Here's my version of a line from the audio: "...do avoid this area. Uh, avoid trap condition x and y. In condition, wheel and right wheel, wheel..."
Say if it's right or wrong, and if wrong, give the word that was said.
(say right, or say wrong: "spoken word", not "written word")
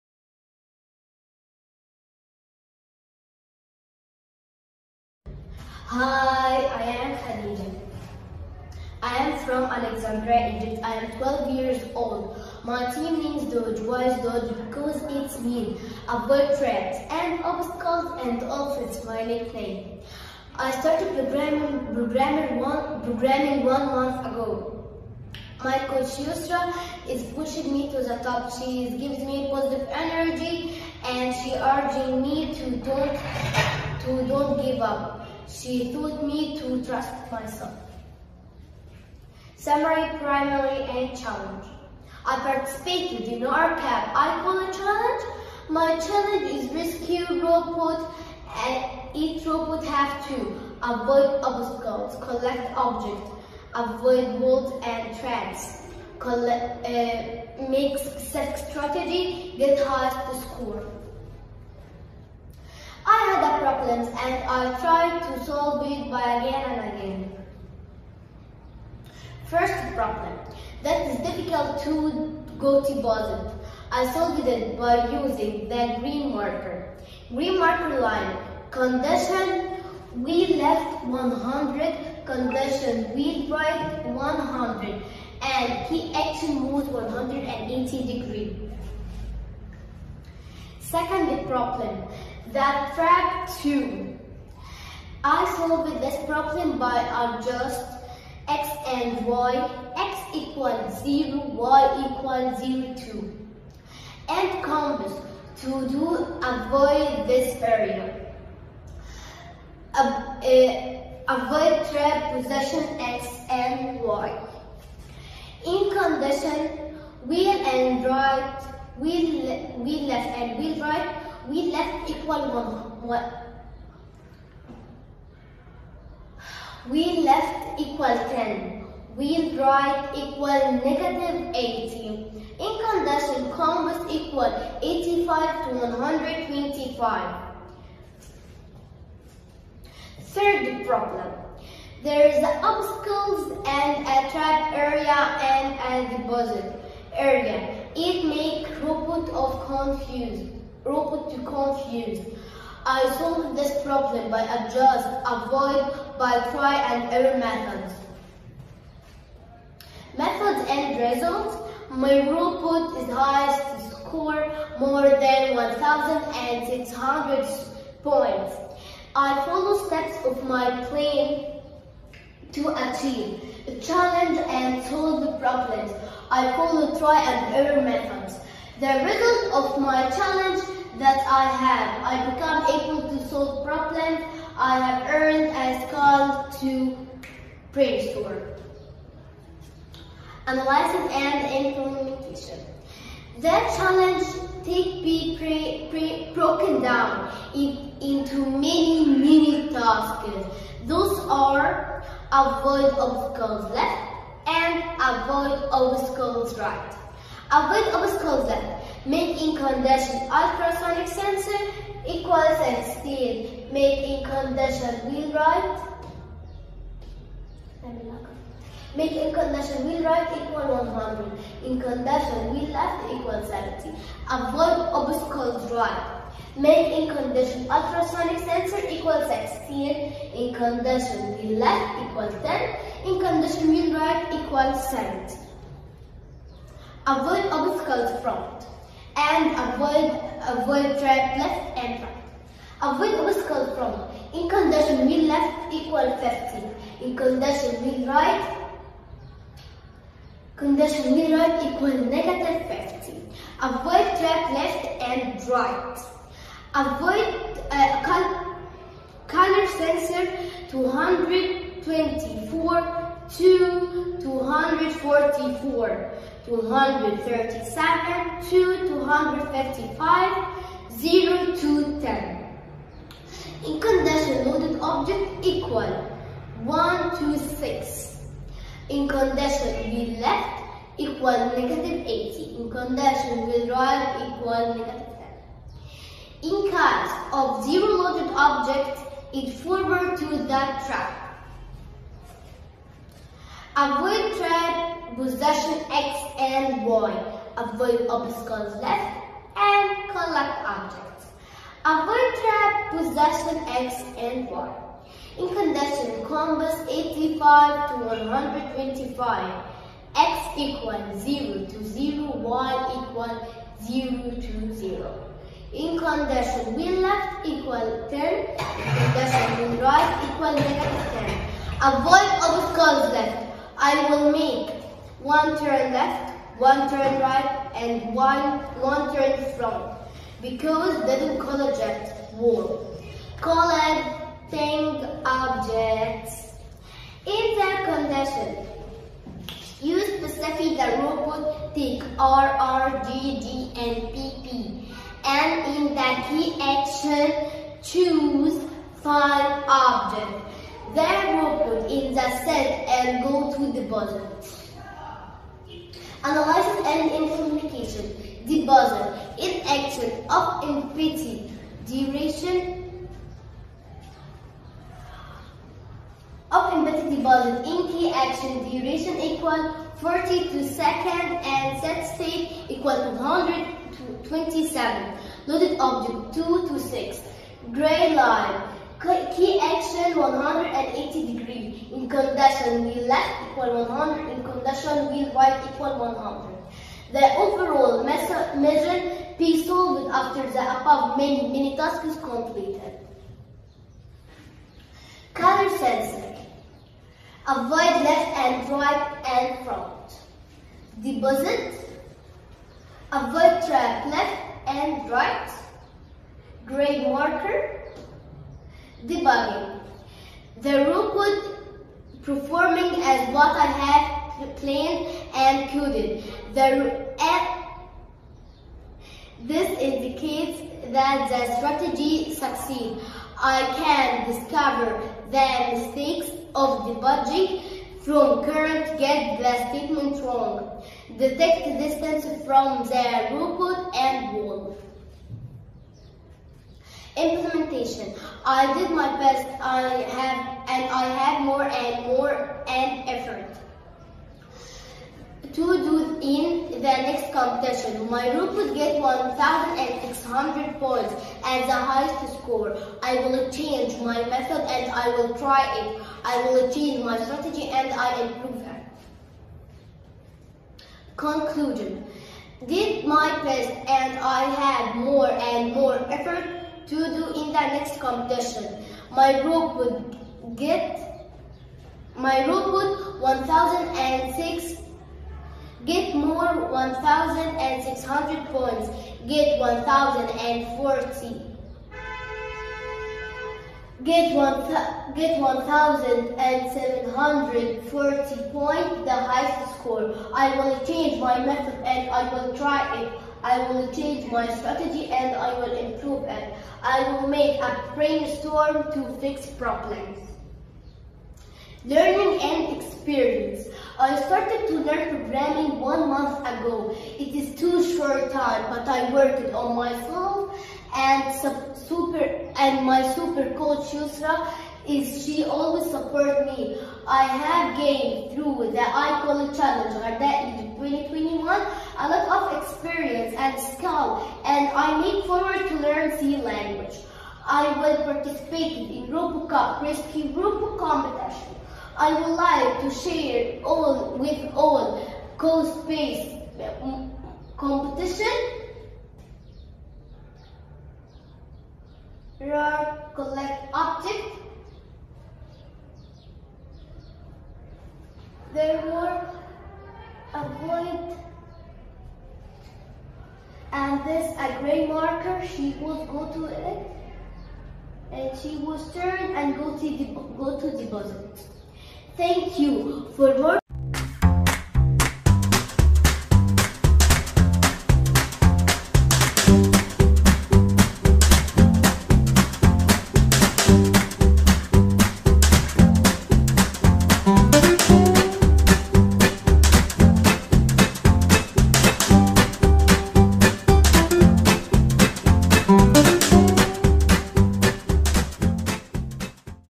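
wrong: "position", not "condition".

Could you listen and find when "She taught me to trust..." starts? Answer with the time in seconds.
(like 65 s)
35 s.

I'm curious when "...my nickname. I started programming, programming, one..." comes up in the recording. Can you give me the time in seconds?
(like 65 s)
19 s.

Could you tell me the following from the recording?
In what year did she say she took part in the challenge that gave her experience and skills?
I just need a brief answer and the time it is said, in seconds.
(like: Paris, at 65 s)
2021, at 520 s.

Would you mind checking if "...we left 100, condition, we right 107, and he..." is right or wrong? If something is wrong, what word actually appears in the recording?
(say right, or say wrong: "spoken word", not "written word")
wrong: "100", not "107".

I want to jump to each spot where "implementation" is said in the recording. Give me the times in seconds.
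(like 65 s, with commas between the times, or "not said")
191 s, 357 s, 437 s.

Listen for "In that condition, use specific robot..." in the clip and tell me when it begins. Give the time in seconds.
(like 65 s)
337 s.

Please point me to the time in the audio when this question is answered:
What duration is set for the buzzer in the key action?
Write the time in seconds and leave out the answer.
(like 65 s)
369 s.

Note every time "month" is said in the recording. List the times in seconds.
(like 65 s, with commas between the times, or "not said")
23 s, 506 s.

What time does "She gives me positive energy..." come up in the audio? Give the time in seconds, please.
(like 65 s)
28 s.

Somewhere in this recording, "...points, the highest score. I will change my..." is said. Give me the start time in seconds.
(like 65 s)
488 s.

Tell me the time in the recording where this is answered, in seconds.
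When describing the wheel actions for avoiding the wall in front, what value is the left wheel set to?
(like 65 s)
245 s.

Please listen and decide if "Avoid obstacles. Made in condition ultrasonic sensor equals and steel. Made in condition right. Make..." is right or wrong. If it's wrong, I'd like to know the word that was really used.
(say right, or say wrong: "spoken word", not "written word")
right.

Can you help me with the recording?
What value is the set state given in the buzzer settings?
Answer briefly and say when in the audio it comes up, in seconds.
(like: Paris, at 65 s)
127, at 373 s.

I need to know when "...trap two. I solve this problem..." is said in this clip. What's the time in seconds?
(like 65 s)
92 s.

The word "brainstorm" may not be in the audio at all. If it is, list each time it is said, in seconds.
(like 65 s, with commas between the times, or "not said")
187 s, 497 s.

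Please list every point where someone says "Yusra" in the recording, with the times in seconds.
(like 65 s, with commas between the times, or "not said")
26 s, 513 s.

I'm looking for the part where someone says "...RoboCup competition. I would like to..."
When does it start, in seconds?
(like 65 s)
530 s.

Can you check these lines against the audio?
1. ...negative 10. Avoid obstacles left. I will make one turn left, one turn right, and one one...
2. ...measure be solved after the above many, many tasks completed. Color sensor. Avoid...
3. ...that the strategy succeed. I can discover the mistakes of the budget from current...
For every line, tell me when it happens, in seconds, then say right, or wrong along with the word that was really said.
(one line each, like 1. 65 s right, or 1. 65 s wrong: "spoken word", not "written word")
1. 320 s right
2. 388 s right
3. 420 s right.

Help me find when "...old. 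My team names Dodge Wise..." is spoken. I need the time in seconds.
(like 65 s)
11 s.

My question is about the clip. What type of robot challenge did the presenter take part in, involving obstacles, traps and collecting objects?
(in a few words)
Rescue robot.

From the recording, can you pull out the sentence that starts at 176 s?
I follow try and error methods.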